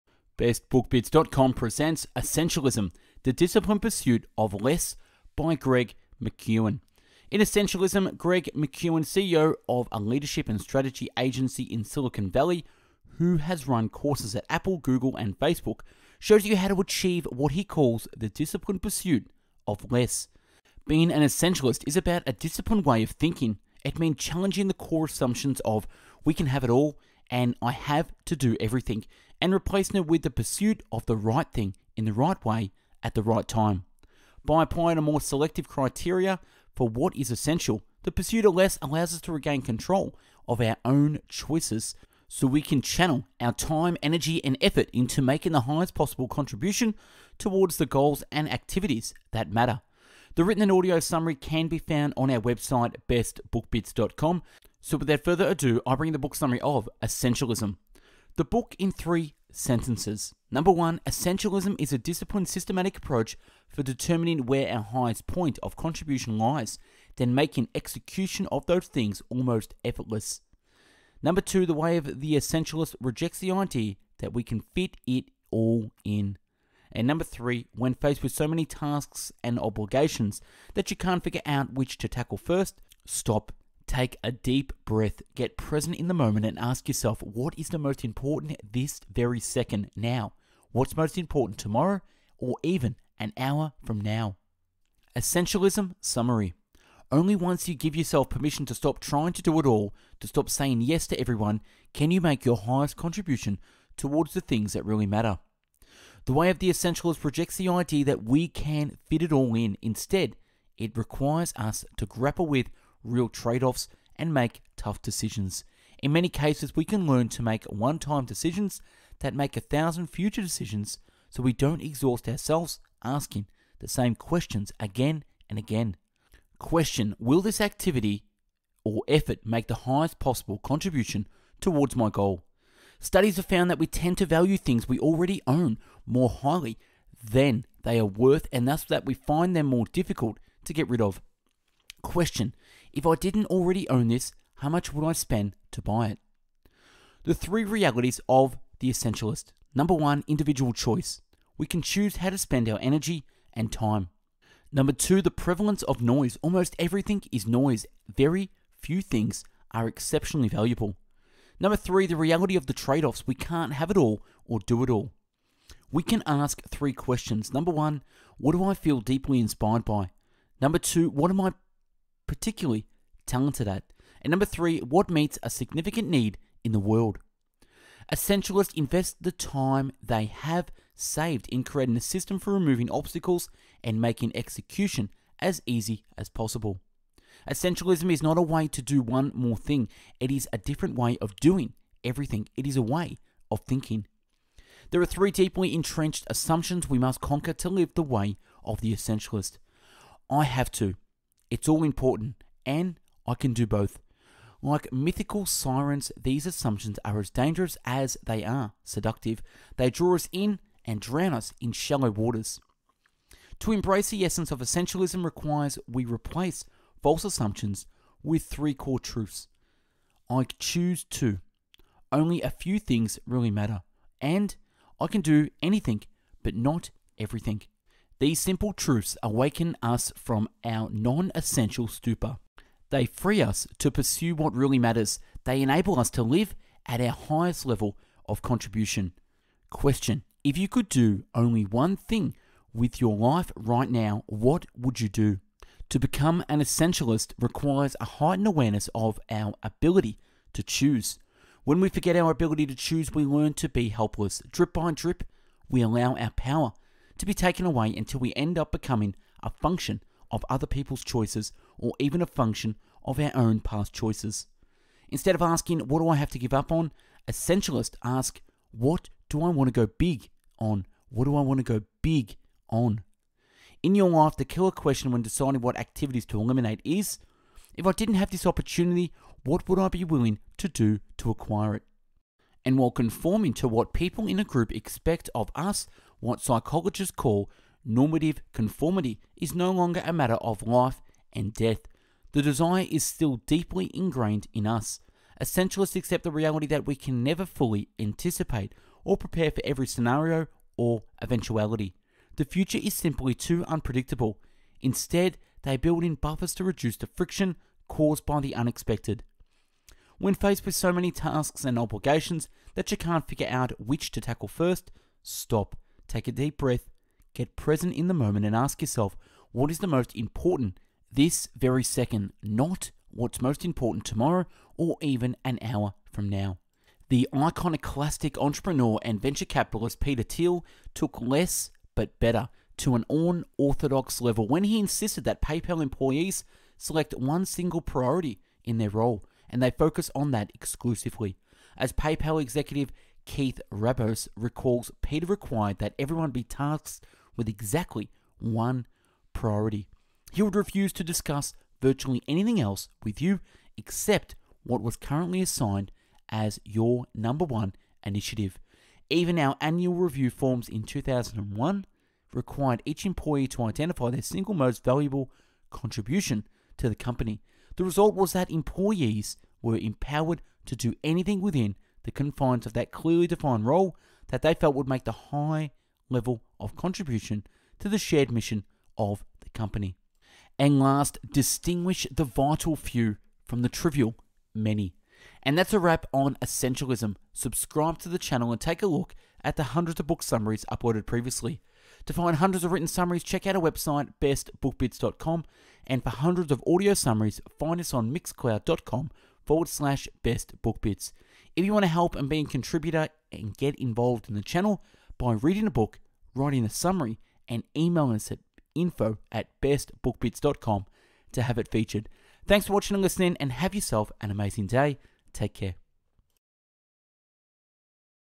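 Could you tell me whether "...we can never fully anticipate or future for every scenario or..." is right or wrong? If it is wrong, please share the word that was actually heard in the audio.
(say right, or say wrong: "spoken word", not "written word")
wrong: "prepare", not "future".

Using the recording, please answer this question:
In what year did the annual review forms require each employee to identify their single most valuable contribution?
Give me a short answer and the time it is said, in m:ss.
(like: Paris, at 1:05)
2001, at 6:00.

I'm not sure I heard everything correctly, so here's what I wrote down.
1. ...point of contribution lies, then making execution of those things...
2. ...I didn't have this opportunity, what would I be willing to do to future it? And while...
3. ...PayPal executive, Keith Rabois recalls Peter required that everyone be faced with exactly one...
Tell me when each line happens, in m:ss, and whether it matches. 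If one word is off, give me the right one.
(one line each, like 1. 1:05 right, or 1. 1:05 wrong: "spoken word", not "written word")
1. 1:05 right
2. 4:37 wrong: "acquire", not "future"
3. 5:41 wrong: "tasked", not "faced".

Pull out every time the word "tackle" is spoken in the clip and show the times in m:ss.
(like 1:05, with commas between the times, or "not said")
1:22, 5:14.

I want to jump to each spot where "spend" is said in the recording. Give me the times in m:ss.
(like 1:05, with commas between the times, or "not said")
2:25, 2:32.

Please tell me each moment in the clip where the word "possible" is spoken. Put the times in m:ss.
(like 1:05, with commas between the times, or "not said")
0:45, 2:10, 3:06.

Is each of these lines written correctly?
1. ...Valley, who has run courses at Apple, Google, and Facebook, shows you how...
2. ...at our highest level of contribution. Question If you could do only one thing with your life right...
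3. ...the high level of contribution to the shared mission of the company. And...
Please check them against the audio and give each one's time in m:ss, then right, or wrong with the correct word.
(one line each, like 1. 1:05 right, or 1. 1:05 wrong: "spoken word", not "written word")
1. 0:12 right
2. 3:56 right
3. 6:15 right.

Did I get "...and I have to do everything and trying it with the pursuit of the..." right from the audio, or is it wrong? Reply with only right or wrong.
wrong.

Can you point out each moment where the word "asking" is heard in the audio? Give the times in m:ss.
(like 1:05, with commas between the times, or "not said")
2:03, 4:25.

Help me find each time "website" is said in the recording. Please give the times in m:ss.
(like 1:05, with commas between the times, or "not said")
0:52, 6:33.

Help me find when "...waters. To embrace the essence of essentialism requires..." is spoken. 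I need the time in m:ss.
3:32.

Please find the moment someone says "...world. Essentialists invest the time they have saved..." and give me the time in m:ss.
2:56.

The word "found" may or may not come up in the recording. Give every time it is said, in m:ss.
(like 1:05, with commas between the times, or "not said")
0:51, 2:13.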